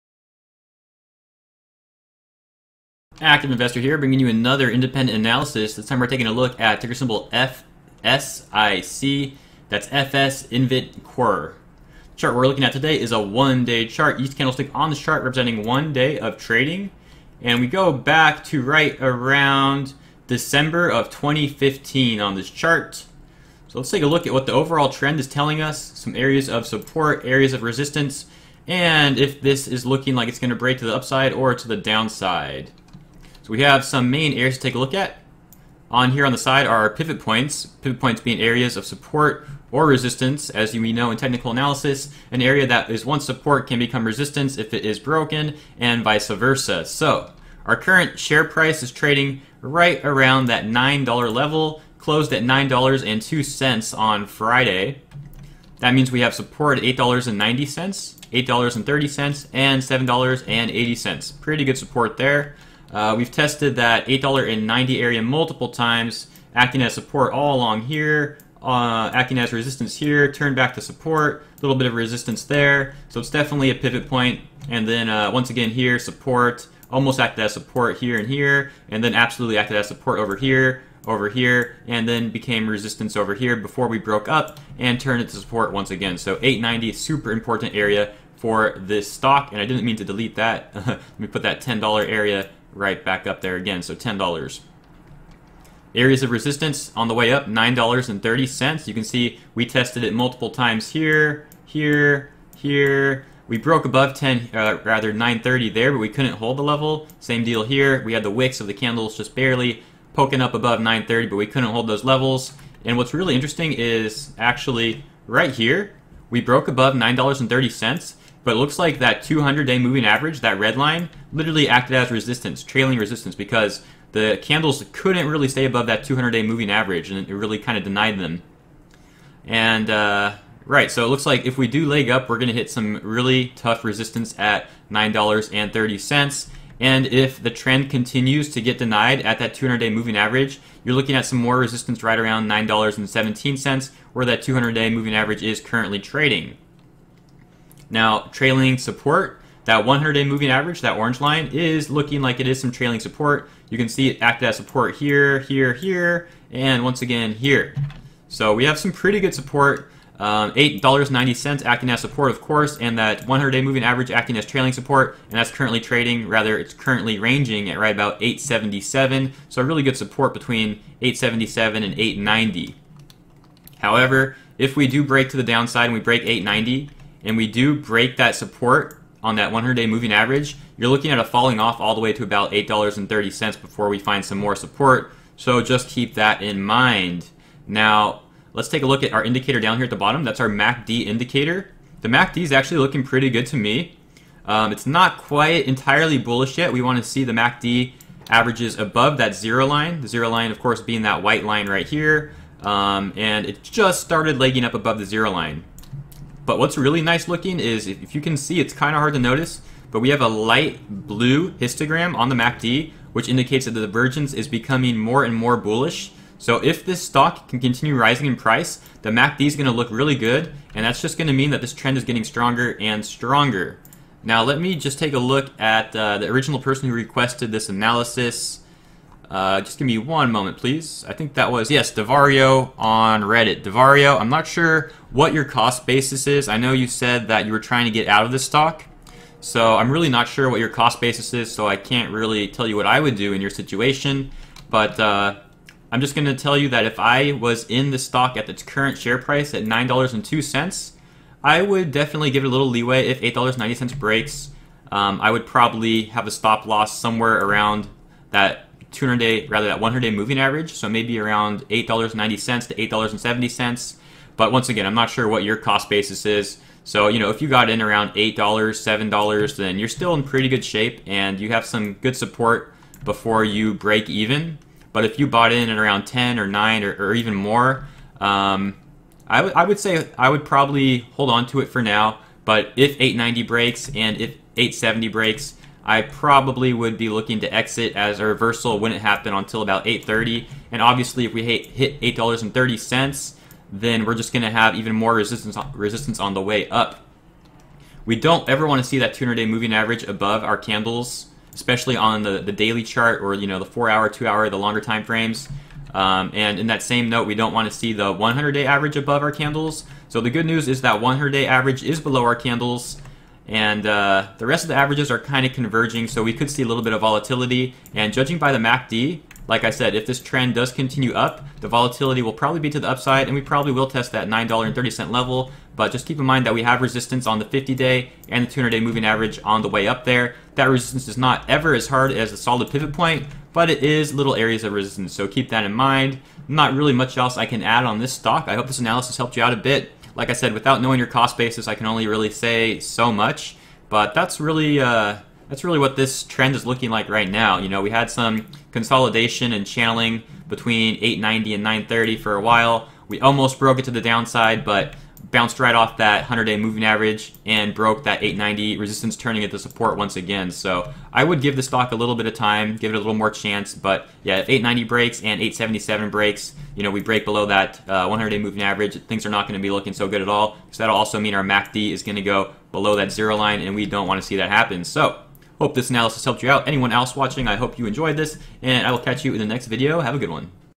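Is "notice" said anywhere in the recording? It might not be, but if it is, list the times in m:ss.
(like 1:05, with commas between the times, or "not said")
3:29.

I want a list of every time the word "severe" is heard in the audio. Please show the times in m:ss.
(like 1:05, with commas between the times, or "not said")
not said.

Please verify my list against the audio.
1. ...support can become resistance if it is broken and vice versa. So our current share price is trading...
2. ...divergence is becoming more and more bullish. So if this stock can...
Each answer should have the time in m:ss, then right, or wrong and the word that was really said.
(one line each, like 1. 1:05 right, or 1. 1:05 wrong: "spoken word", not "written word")
1. 0:43 right
2. 3:33 right.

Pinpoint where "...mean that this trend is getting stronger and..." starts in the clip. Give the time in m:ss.
3:41.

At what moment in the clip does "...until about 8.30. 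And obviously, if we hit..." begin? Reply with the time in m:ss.
4:49.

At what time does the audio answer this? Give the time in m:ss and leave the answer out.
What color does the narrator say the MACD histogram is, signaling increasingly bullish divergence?
3:30.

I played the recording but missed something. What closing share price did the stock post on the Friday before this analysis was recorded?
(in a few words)
$9.02.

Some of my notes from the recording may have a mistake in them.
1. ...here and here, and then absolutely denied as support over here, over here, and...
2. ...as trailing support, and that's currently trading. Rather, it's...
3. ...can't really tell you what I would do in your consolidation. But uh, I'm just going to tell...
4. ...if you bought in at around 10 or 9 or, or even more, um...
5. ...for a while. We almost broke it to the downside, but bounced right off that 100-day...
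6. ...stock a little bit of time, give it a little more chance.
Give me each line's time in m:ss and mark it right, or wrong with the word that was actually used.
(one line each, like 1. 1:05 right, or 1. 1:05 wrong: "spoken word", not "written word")
1. 1:17 wrong: "acted", not "denied"
2. 2:44 right
3. 4:01 wrong: "situation", not "consolidation"
4. 4:35 right
5. 5:52 right
6. 6:01 right.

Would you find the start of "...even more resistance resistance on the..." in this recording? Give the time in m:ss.
4:54.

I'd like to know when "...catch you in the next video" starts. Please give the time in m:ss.
6:18.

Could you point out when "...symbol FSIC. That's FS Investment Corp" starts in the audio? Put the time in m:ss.
0:06.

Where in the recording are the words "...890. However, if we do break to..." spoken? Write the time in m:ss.
2:51.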